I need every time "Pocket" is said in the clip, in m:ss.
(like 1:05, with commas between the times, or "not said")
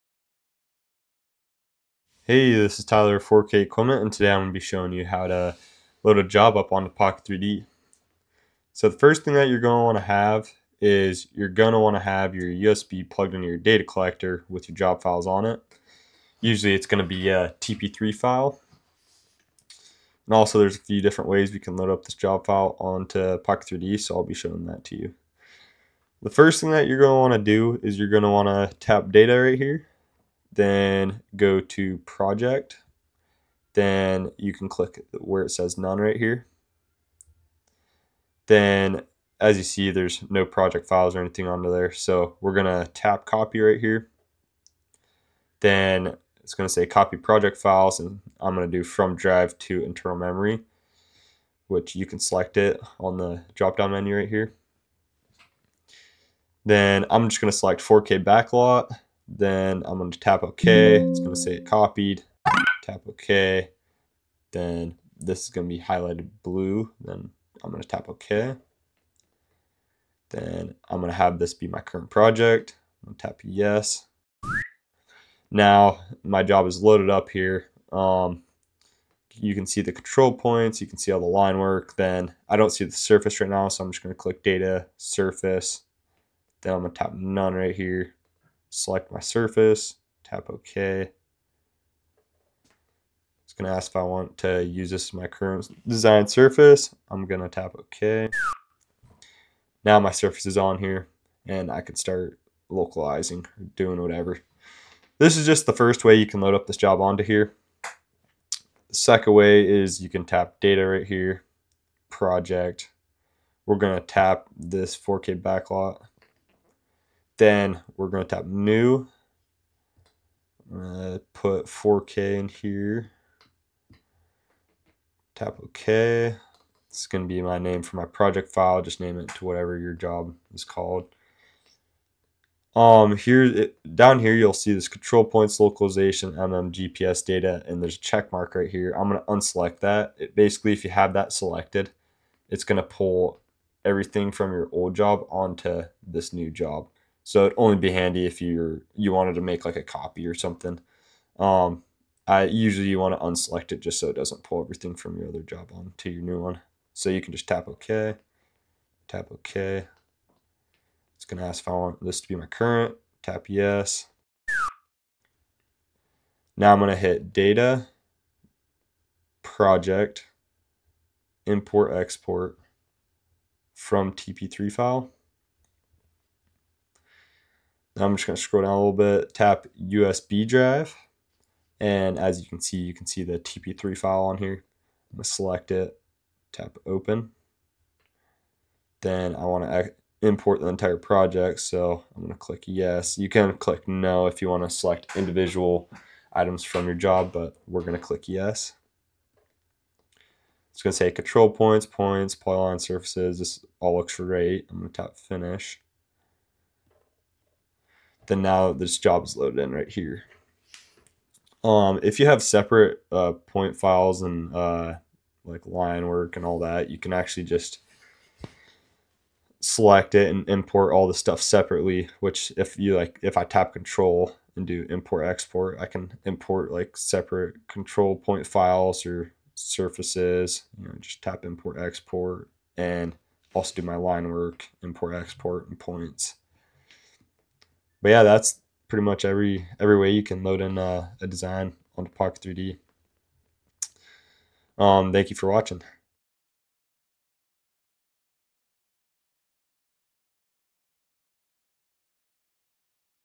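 0:06, 0:23, 4:02.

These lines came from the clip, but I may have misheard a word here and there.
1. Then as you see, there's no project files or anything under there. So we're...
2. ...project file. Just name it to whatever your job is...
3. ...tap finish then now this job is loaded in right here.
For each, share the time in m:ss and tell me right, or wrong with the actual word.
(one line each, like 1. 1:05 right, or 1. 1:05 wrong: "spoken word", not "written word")
1. 0:38 right
2. 2:08 right
3. 3:25 right.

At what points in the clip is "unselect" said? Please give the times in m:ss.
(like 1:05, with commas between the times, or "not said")
2:19, 2:33.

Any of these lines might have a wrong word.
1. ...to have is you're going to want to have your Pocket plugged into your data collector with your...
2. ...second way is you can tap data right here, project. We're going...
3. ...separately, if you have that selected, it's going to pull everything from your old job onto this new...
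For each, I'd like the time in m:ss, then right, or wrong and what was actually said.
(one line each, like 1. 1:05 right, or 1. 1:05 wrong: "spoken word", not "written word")
1. 0:09 wrong: "USB", not "Pocket"
2. 1:48 right
3. 2:20 wrong: "basically", not "separately".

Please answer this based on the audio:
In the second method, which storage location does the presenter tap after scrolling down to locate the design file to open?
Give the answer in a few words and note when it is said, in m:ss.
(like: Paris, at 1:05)
USB drive, at 2:59.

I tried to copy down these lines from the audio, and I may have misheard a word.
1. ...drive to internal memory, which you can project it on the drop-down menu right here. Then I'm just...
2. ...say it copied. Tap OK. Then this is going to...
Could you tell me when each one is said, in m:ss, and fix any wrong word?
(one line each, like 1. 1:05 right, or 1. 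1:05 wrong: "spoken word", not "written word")
1. 0:49 wrong: "select", not "project"
2. 1:01 right.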